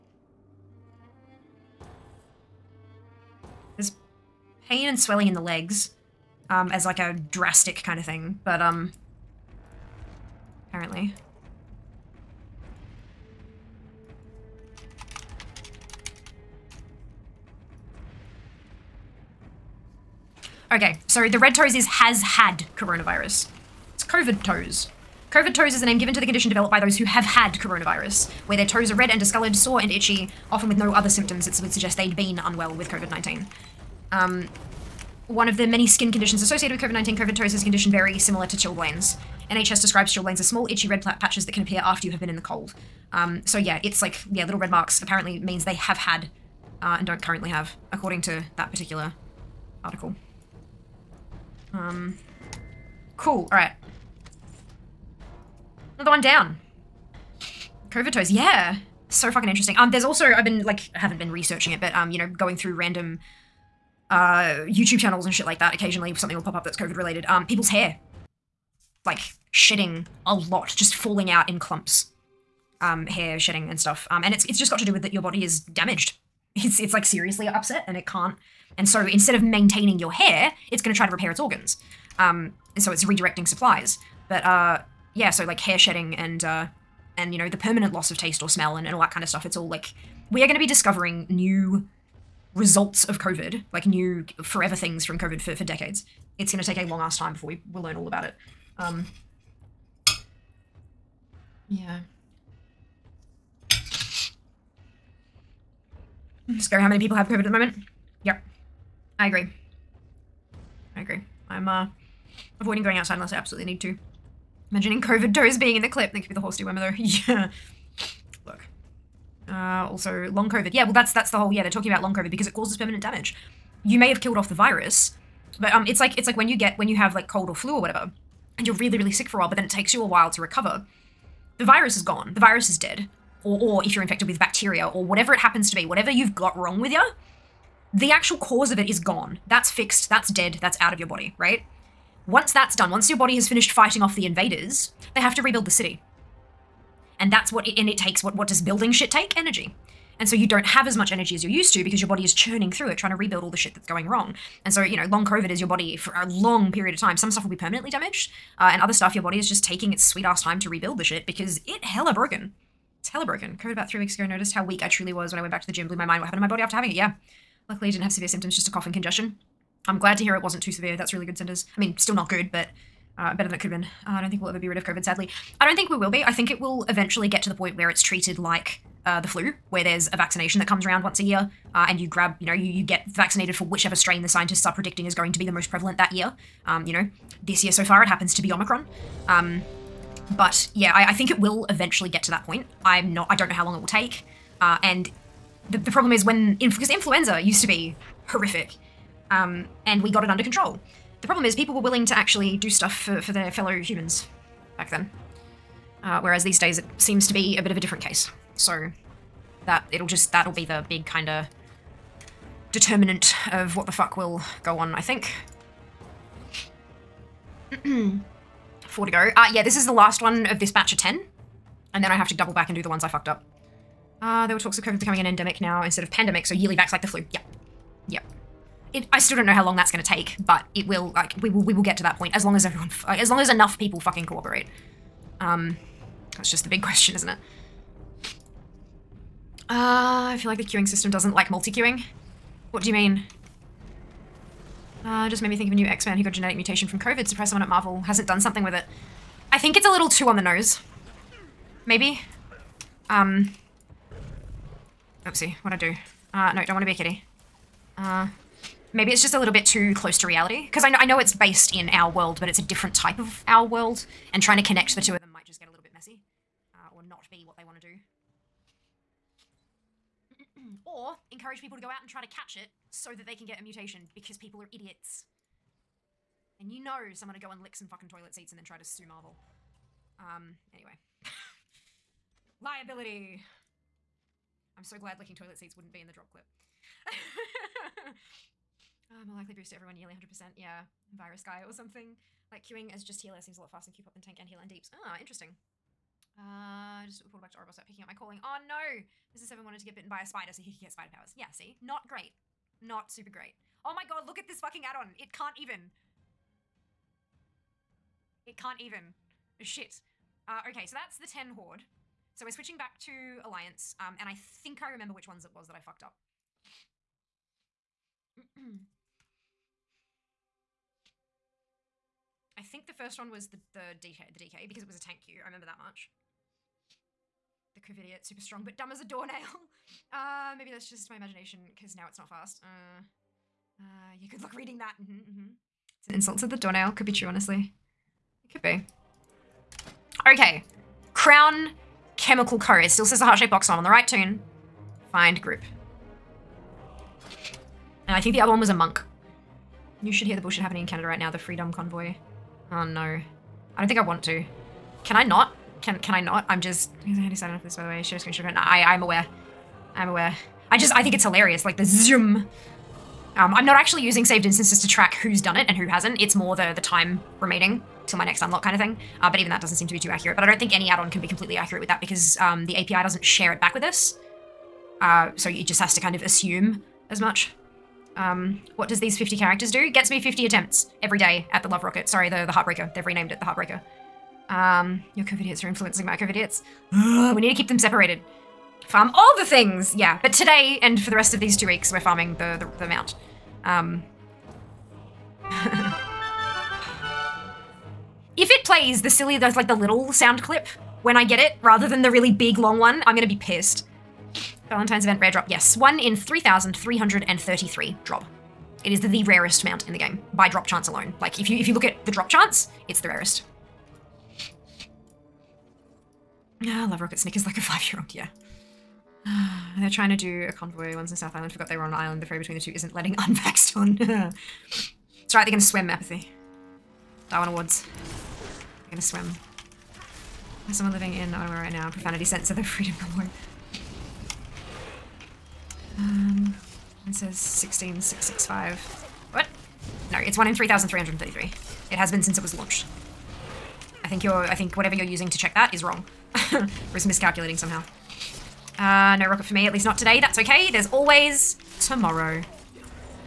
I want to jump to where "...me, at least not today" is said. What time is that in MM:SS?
07:29.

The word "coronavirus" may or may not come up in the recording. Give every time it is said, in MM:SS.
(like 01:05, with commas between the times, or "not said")
00:22, 00:27.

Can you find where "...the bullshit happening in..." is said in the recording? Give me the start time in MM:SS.
05:50.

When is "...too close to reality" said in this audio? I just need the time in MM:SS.
04:19.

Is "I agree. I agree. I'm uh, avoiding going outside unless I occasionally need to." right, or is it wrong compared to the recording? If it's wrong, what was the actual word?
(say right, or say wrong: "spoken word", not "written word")
wrong: "absolutely", not "occasionally".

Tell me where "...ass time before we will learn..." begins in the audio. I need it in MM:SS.
01:36.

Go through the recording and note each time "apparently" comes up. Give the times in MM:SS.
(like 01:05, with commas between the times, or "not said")
00:10, 00:45.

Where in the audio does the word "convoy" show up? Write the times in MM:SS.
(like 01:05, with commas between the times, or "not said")
05:51, 07:00.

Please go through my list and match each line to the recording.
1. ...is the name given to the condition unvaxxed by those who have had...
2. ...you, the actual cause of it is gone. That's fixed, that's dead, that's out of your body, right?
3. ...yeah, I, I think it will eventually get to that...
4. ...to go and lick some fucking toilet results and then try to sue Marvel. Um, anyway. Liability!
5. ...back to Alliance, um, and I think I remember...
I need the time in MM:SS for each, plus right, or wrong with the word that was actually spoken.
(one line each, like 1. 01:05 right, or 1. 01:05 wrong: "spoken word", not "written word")
1. 00:25 wrong: "developed", not "unvaxxed"
2. 02:16 right
3. 03:10 right
4. 04:37 wrong: "seats", not "results"
5. 05:12 right.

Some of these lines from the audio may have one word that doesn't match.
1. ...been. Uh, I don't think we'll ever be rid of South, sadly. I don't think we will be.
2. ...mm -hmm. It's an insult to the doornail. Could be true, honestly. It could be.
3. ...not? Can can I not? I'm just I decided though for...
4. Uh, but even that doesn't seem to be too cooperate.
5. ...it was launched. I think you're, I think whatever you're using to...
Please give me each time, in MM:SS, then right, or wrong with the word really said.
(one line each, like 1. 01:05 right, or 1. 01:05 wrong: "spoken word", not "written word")
1. 02:53 wrong: "COVID", not "South"
2. 05:35 right
3. 05:55 wrong: "enough", not "though"
4. 06:09 wrong: "accurate", not "cooperate"
5. 07:22 right.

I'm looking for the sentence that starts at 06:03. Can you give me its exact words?
Um, I'm not actually using saved instances to track who's done it and who hasn't.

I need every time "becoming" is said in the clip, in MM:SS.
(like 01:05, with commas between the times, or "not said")
03:44.